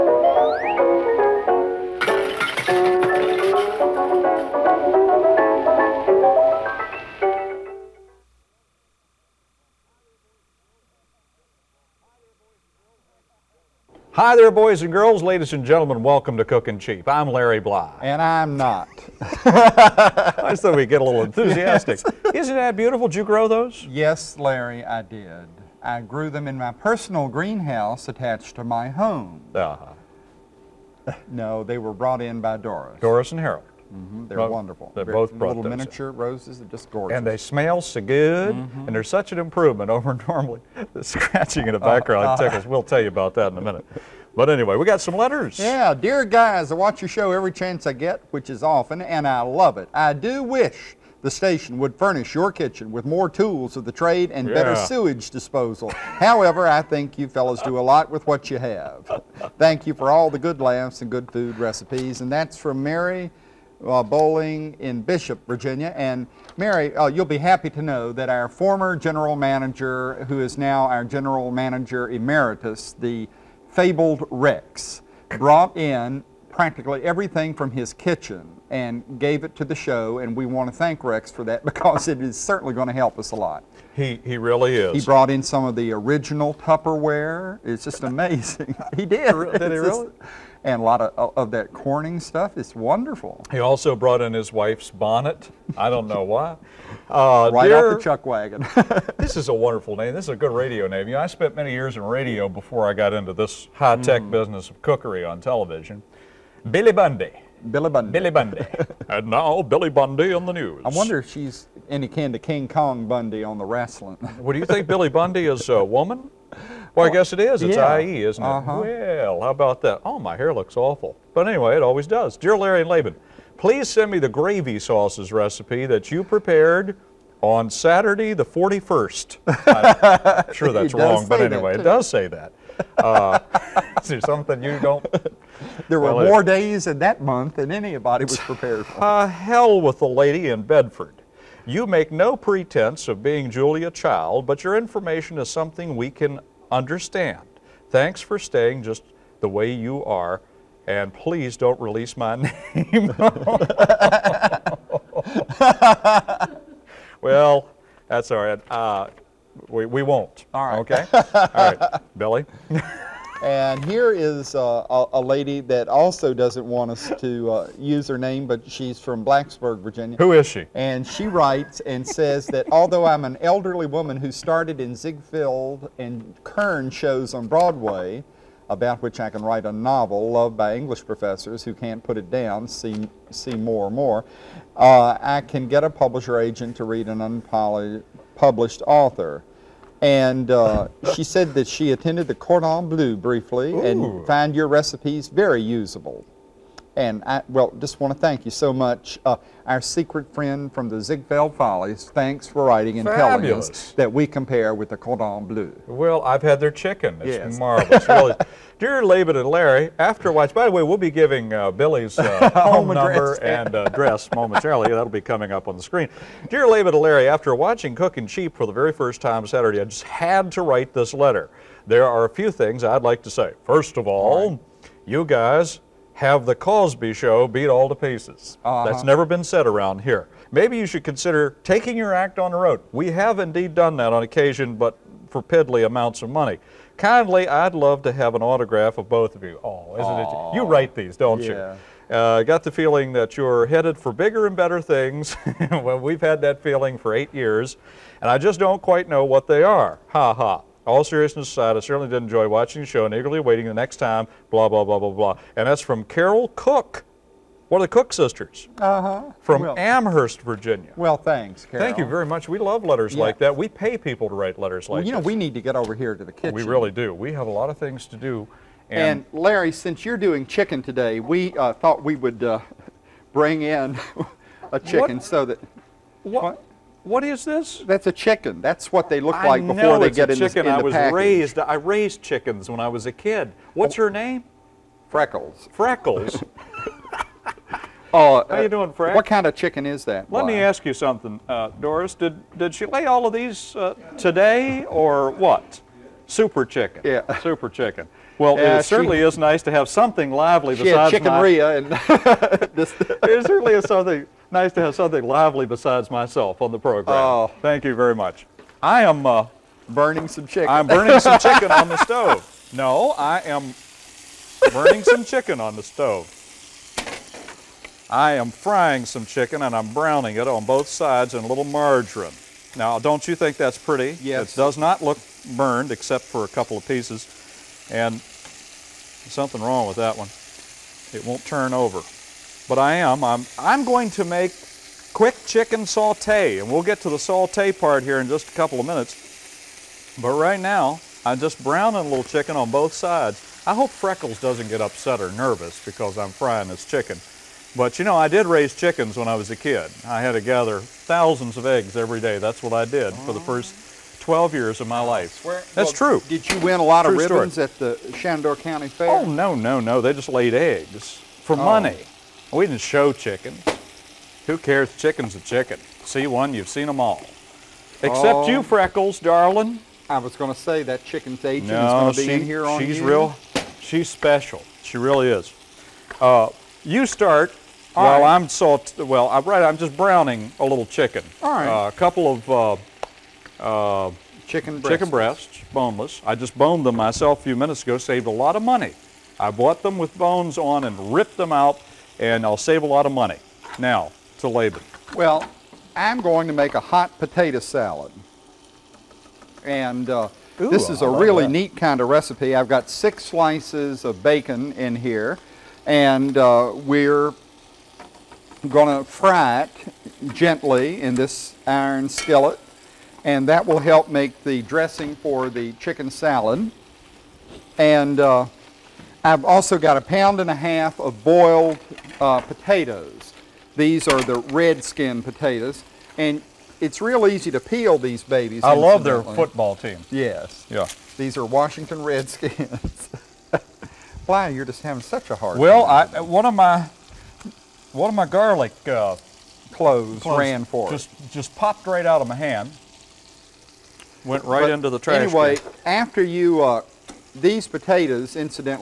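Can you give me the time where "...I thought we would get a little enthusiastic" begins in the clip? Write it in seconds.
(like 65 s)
19 s.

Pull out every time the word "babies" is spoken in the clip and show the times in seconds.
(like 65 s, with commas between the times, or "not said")
428 s.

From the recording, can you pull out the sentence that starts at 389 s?
I bought them with bones on and ripped them out, and I'll save a lot of money.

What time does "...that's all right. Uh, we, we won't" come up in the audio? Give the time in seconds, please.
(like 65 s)
158 s.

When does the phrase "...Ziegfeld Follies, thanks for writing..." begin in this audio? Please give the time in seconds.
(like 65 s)
200 s.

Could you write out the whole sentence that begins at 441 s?
Just just popped right out of my hand.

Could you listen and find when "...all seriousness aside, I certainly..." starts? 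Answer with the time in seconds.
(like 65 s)
250 s.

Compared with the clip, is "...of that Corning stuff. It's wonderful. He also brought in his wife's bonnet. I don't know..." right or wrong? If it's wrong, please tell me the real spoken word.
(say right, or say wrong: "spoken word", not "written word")
right.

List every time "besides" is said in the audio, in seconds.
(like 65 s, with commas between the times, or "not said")
300 s, 305 s.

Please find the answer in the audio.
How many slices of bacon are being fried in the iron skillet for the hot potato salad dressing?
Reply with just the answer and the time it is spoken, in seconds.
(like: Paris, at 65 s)
6, at 402 s.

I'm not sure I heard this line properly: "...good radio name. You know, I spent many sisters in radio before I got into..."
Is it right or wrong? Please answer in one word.
wrong.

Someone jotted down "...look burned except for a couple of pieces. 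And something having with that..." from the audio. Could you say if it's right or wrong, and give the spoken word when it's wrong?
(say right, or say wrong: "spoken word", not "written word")
wrong: "wrong", not "having".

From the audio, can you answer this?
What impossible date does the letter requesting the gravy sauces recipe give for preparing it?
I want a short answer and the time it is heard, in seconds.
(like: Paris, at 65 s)
Saturday the 41st, at 127 s.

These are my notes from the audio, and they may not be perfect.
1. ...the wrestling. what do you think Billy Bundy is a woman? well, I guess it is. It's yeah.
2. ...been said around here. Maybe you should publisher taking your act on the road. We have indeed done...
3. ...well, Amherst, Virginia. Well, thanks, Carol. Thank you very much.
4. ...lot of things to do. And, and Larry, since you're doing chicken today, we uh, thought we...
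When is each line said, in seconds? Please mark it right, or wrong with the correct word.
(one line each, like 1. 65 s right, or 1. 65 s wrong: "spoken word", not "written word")
1. 113 s right
2. 229 s wrong: "consider", not "publisher"
3. 259 s right
4. 267 s right.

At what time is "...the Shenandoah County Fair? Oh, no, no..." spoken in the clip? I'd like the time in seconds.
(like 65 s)
357 s.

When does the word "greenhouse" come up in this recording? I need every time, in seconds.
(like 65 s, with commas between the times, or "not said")
27 s.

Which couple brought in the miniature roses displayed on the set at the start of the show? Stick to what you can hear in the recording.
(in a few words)
Doris and Harold.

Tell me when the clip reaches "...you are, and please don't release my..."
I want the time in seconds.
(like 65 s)
149 s.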